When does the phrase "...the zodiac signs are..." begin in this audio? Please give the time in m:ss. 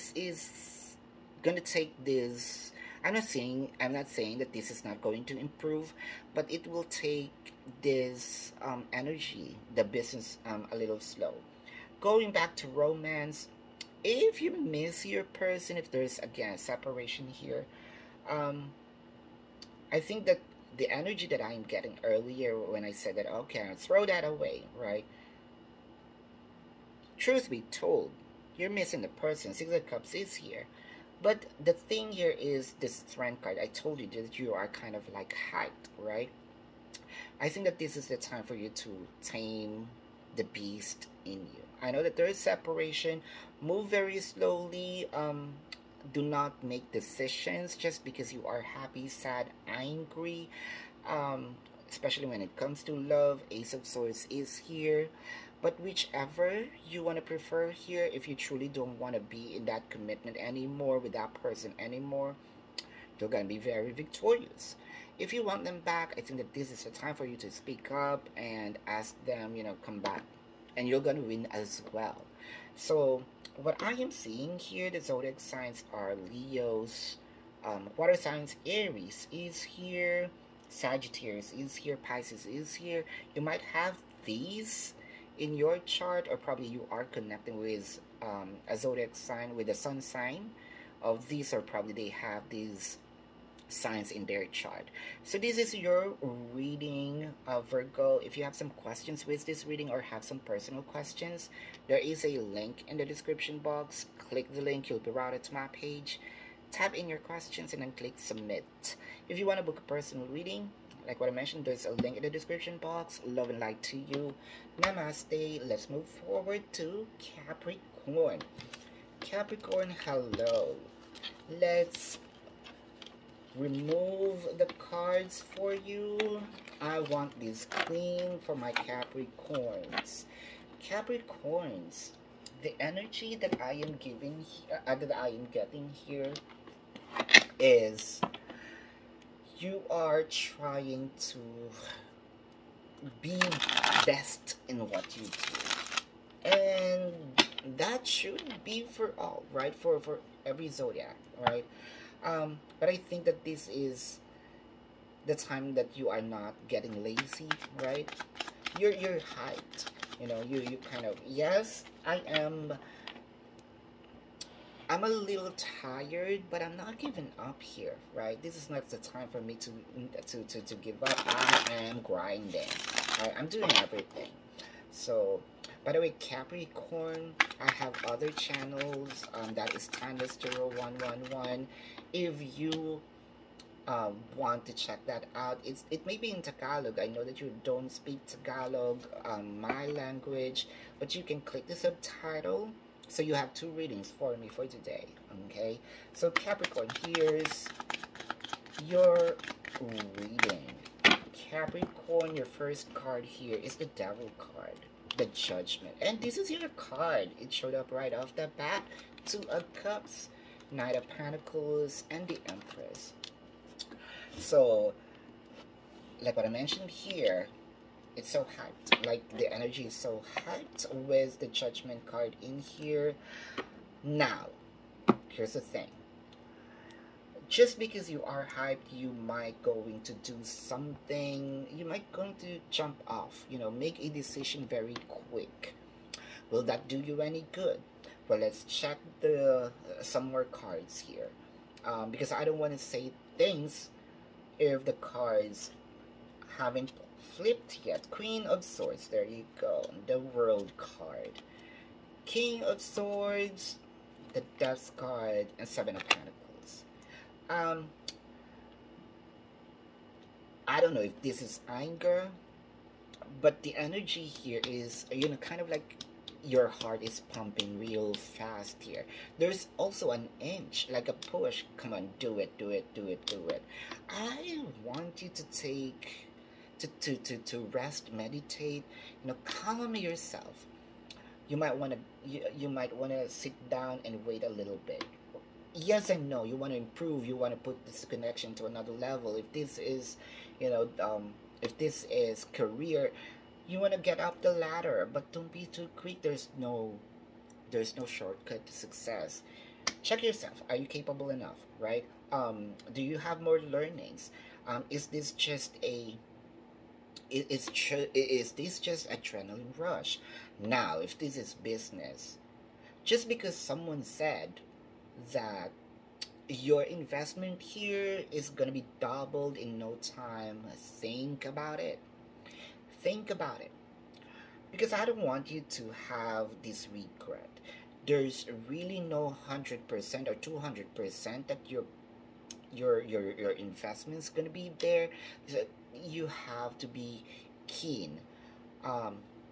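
1:14.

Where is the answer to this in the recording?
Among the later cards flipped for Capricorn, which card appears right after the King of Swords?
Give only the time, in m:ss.
4:14.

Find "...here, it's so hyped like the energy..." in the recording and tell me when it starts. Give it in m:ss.
3:36.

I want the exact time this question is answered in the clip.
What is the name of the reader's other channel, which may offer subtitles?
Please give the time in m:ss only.
2:59.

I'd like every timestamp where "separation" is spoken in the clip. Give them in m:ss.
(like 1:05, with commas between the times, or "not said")
0:16, 0:42.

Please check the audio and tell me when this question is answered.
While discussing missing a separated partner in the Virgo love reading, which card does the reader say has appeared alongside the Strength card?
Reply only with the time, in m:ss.
0:29.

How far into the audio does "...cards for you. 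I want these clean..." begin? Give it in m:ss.
2:04.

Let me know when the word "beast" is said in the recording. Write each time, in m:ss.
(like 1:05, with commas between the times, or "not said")
0:40.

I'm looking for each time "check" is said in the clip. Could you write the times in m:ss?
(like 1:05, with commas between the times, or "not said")
3:04, 3:58, 5:00.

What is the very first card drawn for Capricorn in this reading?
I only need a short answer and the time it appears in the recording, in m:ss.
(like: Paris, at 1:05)
The Devil, at 3:23.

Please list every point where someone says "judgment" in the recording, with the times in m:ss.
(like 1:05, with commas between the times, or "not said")
3:25, 3:41.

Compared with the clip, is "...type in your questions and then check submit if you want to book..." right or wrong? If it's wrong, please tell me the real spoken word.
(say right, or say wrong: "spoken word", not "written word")
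wrong: "click", not "check".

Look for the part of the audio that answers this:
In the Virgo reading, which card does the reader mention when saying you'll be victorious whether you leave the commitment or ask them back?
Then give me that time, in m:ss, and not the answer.
0:53.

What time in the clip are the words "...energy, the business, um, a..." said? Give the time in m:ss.
0:08.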